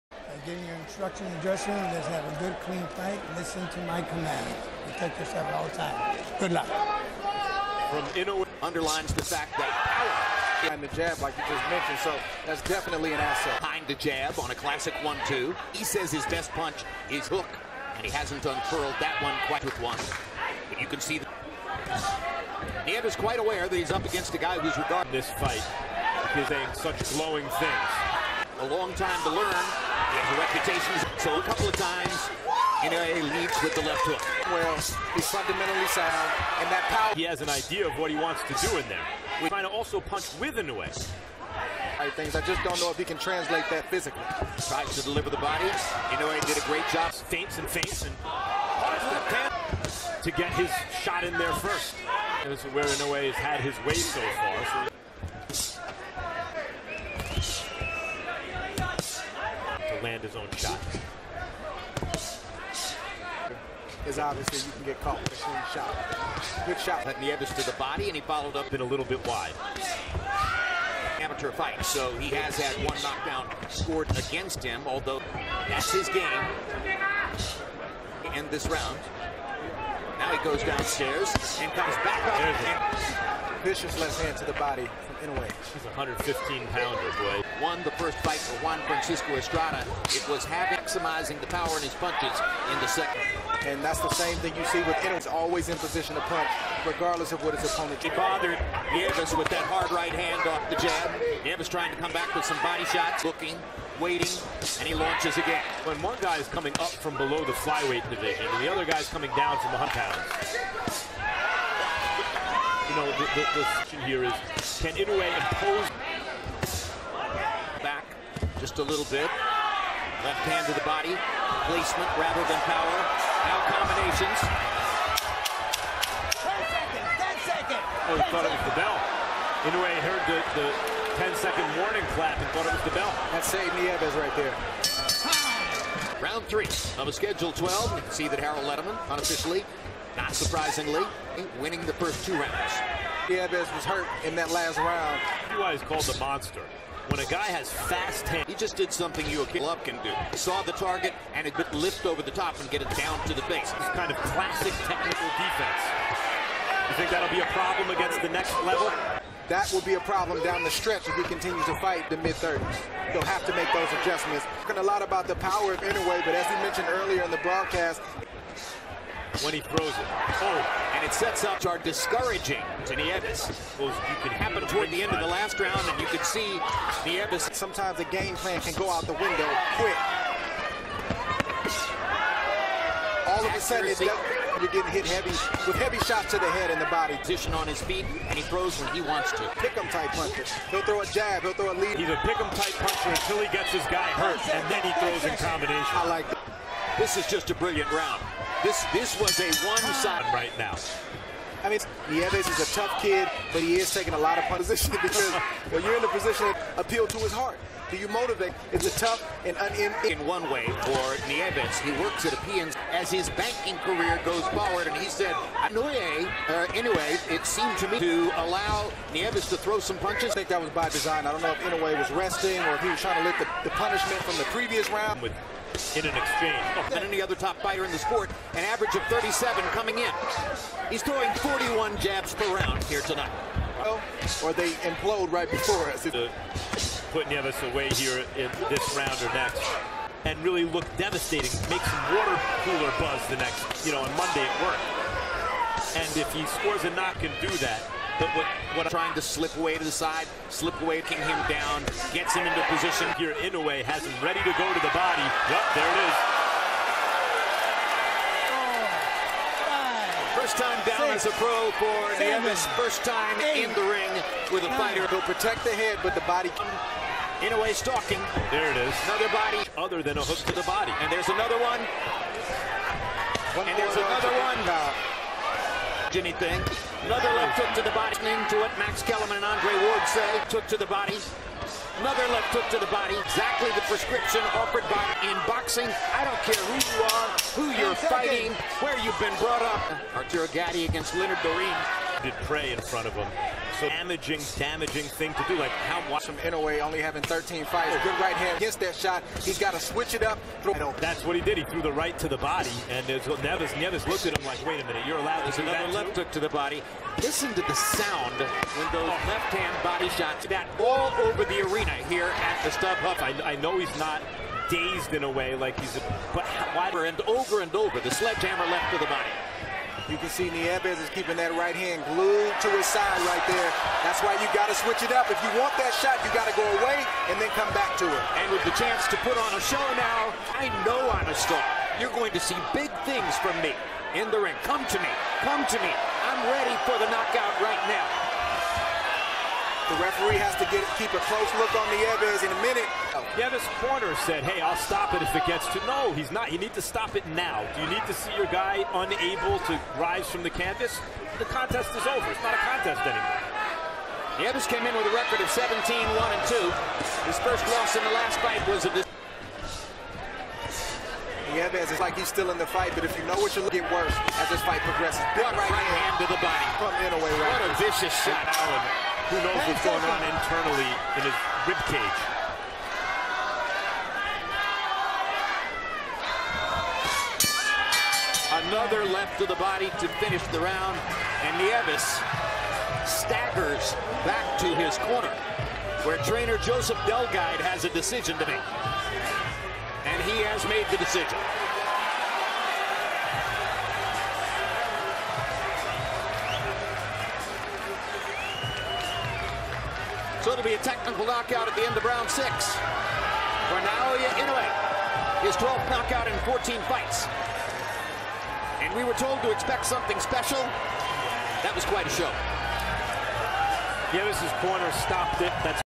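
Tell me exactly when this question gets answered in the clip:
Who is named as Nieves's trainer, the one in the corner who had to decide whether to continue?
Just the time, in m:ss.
6:26.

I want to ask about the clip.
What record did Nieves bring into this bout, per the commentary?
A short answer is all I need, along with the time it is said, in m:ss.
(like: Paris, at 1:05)
17-1-2, at 5:55.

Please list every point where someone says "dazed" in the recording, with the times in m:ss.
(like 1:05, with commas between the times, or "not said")
5:14.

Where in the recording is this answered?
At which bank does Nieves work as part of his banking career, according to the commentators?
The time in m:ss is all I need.
3:32.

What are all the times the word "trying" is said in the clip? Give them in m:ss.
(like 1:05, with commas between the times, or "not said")
0:39, 1:41, 3:43, 4:08.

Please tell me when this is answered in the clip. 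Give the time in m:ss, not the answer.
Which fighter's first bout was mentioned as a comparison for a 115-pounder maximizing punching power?
1:28.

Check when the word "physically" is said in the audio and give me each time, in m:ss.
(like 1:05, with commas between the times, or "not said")
0:43.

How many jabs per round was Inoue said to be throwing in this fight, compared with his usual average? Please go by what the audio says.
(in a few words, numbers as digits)
41.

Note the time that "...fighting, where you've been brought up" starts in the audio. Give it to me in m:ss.
4:47.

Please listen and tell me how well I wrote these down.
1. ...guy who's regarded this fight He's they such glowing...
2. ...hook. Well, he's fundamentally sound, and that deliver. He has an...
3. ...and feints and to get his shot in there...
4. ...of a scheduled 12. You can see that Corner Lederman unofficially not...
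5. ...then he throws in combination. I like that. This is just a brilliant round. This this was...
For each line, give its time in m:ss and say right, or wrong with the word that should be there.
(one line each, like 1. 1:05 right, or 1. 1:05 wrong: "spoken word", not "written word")
1. 0:24 right
2. 0:34 wrong: "power", not "deliver"
3. 0:47 right
4. 2:17 wrong: "Harold", not "Corner"
5. 3:14 right.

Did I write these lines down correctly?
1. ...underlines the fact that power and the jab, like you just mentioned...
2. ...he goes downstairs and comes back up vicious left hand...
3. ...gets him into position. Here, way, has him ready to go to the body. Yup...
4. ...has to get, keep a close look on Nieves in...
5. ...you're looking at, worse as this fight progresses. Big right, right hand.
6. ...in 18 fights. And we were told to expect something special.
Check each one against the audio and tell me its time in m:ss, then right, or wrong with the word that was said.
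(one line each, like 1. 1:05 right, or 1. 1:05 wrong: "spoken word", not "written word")
1. 0:08 right
2. 1:20 right
3. 4:12 right
4. 5:40 right
5. 6:03 right
6. 6:46 wrong: "14", not "18".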